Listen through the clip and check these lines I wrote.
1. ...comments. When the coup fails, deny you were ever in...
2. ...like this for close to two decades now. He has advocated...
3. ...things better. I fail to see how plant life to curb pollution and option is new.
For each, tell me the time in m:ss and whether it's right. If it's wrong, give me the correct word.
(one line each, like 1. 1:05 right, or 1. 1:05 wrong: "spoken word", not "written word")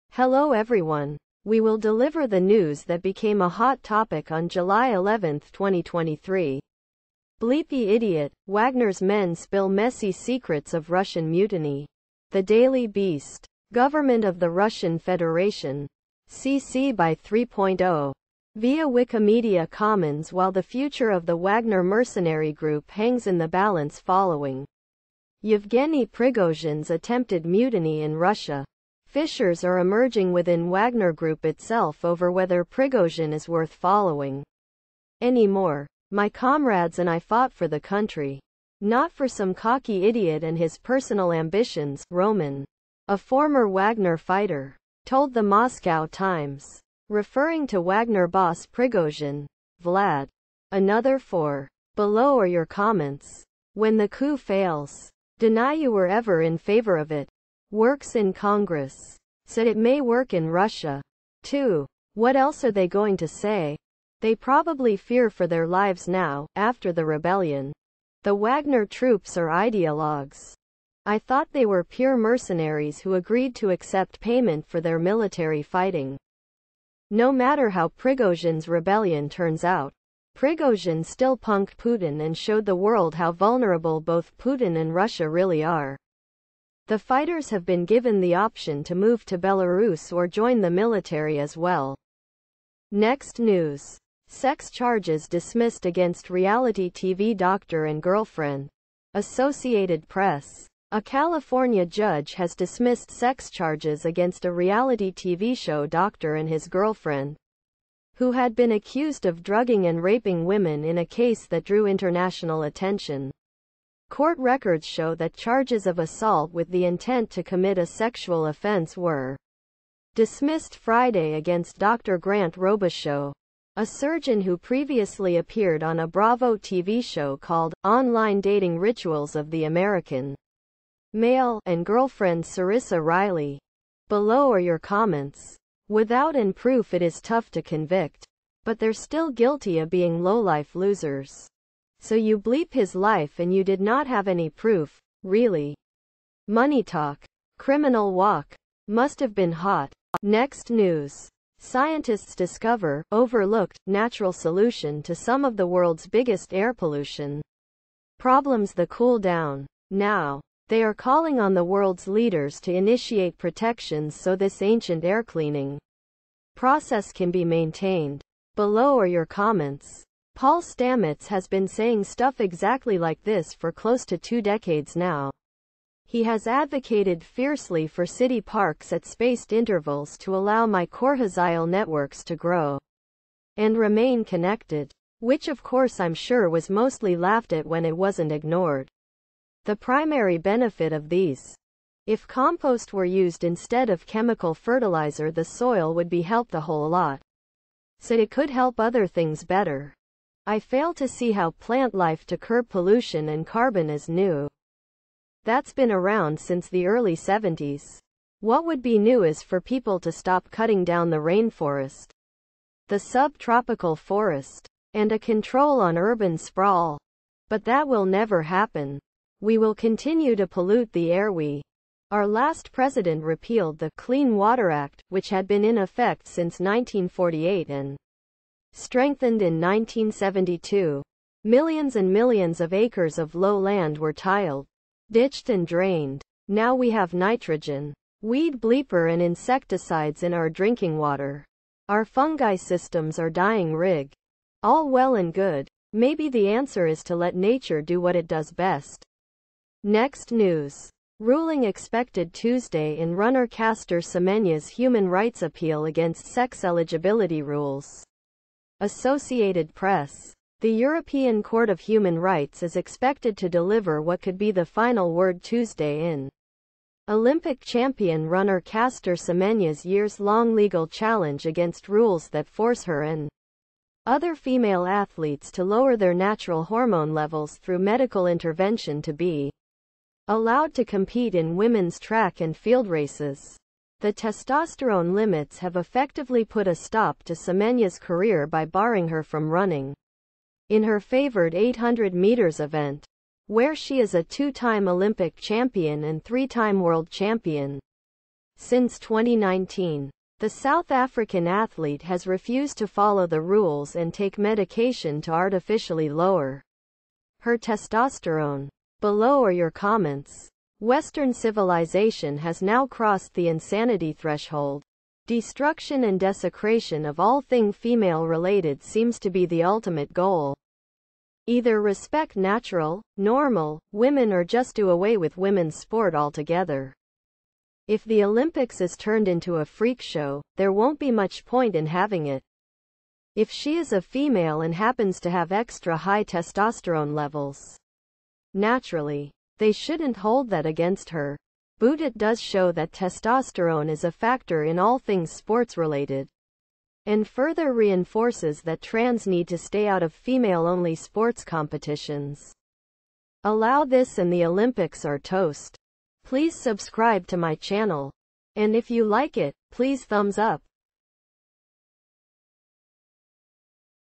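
1. 0:52 right
2. 2:52 right
3. 3:19 wrong: "carbon", not "option".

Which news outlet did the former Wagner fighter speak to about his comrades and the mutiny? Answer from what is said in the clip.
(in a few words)
The Moscow Times.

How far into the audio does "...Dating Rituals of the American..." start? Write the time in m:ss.
2:08.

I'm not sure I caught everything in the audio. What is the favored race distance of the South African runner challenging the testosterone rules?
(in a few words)
800 meters.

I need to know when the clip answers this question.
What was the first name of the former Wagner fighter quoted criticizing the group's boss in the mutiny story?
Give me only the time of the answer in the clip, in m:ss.
0:42.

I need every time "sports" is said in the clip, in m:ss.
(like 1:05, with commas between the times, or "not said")
5:25, 5:45, 5:50.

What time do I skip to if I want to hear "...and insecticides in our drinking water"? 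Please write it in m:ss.
3:59.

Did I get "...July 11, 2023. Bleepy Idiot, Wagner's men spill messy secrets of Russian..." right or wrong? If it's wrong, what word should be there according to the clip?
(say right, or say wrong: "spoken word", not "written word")
right.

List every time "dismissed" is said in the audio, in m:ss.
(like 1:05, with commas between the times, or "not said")
1:35, 1:42, 2:00.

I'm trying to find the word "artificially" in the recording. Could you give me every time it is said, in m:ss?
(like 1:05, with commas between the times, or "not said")
5:05.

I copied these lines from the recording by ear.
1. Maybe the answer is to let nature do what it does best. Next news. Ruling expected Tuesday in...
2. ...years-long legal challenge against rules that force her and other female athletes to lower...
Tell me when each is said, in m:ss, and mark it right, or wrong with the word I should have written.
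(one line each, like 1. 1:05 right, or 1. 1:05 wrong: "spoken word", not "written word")
1. 4:05 right
2. 4:29 right.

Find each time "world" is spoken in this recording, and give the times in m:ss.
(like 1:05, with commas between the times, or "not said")
1:22, 2:35, 2:41, 4:56.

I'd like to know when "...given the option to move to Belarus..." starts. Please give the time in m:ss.
1:27.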